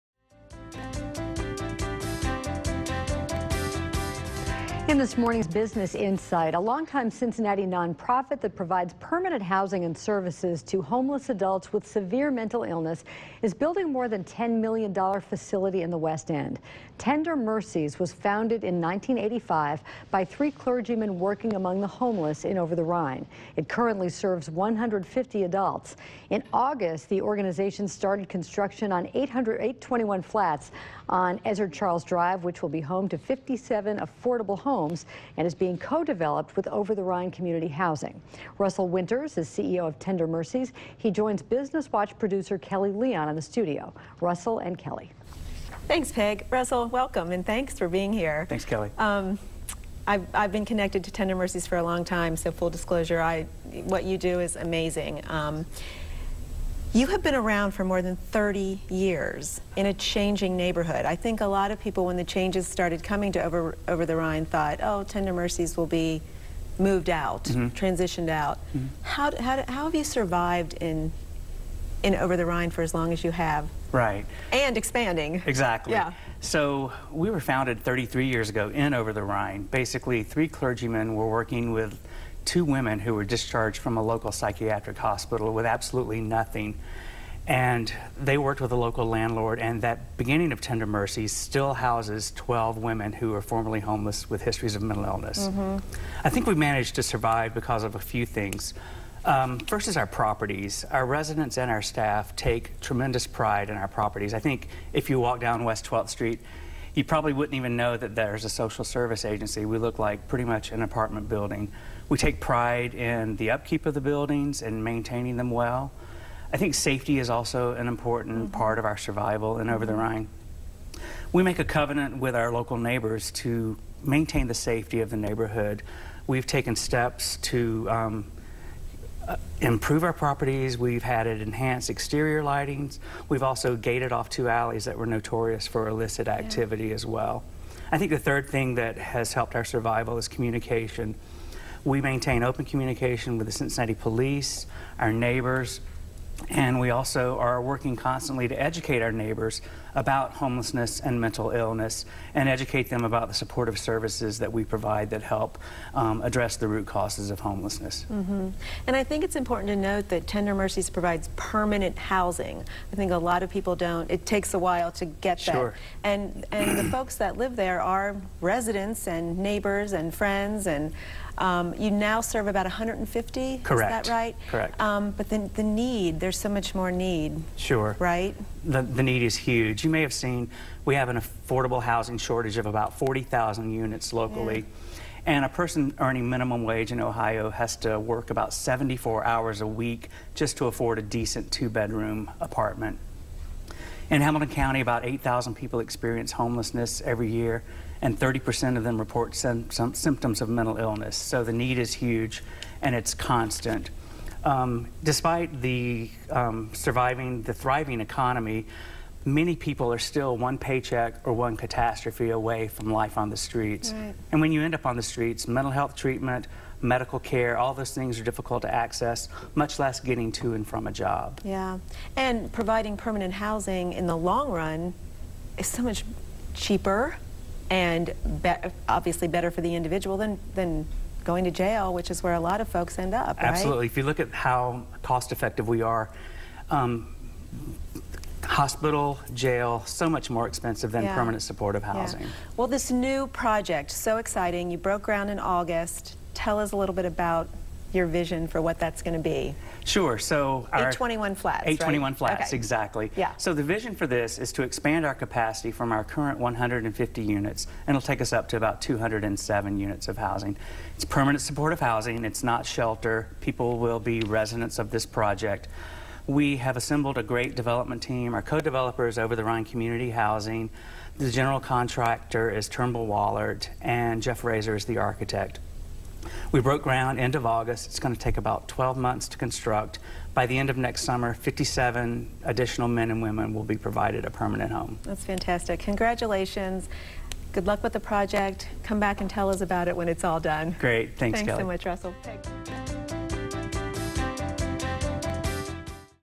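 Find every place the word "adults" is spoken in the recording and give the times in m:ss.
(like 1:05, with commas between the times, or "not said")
0:11, 0:25.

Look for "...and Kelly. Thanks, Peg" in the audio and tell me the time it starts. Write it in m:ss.
0:44.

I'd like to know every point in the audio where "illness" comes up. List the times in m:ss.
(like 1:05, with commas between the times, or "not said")
0:12, 1:35, 2:31, 3:20.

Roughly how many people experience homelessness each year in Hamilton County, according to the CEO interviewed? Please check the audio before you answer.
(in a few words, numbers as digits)
8,000.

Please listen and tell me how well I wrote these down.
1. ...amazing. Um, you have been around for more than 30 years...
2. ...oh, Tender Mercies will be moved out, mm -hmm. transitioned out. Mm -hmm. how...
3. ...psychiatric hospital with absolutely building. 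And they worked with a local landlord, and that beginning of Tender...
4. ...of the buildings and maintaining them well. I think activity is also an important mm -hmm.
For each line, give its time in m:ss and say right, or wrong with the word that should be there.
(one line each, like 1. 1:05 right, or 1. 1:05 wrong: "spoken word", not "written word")
1. 0:54 right
2. 1:04 right
3. 1:24 wrong: "nothing", not "building"
4. 1:53 wrong: "safety", not "activity".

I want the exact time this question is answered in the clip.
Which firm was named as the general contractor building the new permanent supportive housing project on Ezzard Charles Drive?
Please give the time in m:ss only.
4:32.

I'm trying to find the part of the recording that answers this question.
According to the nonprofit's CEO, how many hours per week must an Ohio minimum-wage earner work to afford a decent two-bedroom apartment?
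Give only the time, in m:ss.
3:08.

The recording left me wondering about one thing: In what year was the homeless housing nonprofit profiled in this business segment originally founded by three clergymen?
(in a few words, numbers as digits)
1985.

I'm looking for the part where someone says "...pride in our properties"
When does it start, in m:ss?
1:43.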